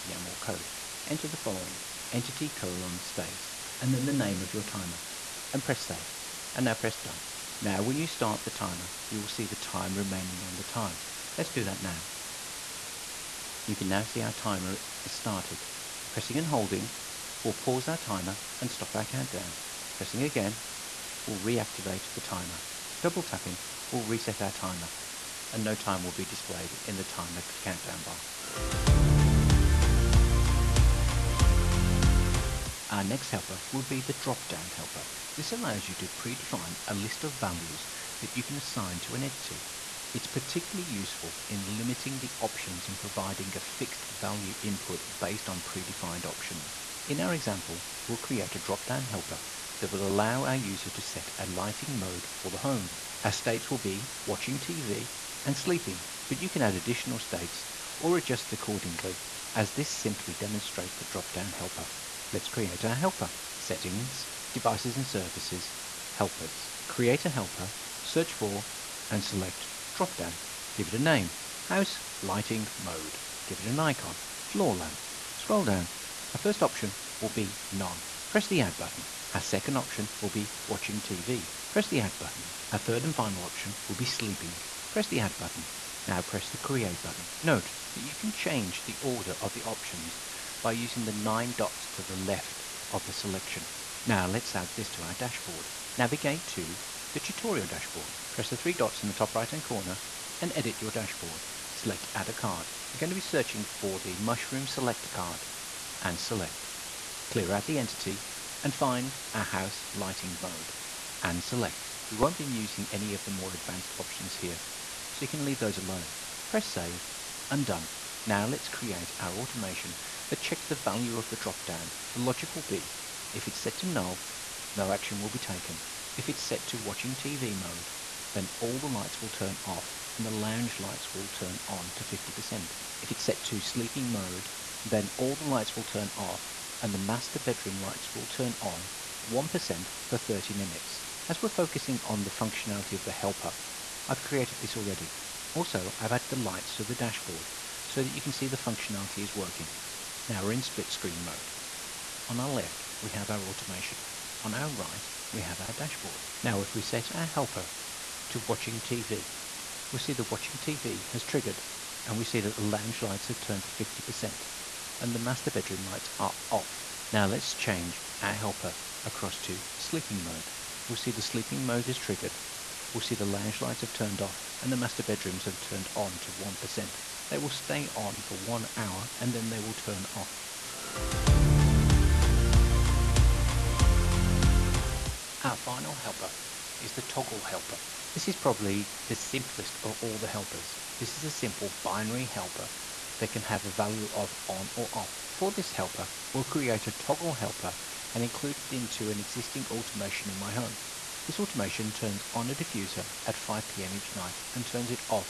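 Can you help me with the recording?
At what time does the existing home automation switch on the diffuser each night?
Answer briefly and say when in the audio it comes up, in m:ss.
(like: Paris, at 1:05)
5 pm, at 3:23.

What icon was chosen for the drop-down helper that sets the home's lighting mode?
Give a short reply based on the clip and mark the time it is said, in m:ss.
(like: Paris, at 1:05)
floor lamp, at 1:14.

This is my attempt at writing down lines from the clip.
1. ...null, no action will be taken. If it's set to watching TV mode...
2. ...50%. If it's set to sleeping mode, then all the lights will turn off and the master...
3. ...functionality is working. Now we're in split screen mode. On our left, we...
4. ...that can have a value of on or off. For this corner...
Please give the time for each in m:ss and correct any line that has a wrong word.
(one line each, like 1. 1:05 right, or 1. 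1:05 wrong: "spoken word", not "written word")
1. 2:03 right
2. 2:12 right
3. 2:28 right
4. 3:13 wrong: "helper", not "corner".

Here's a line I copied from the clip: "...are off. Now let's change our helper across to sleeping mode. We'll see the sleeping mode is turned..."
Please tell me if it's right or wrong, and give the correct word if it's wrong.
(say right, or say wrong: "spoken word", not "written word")
wrong: "triggered", not "turned".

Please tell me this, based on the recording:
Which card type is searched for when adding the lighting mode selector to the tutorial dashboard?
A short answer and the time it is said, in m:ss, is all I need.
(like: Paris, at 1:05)
Mushroom Select card, at 1:44.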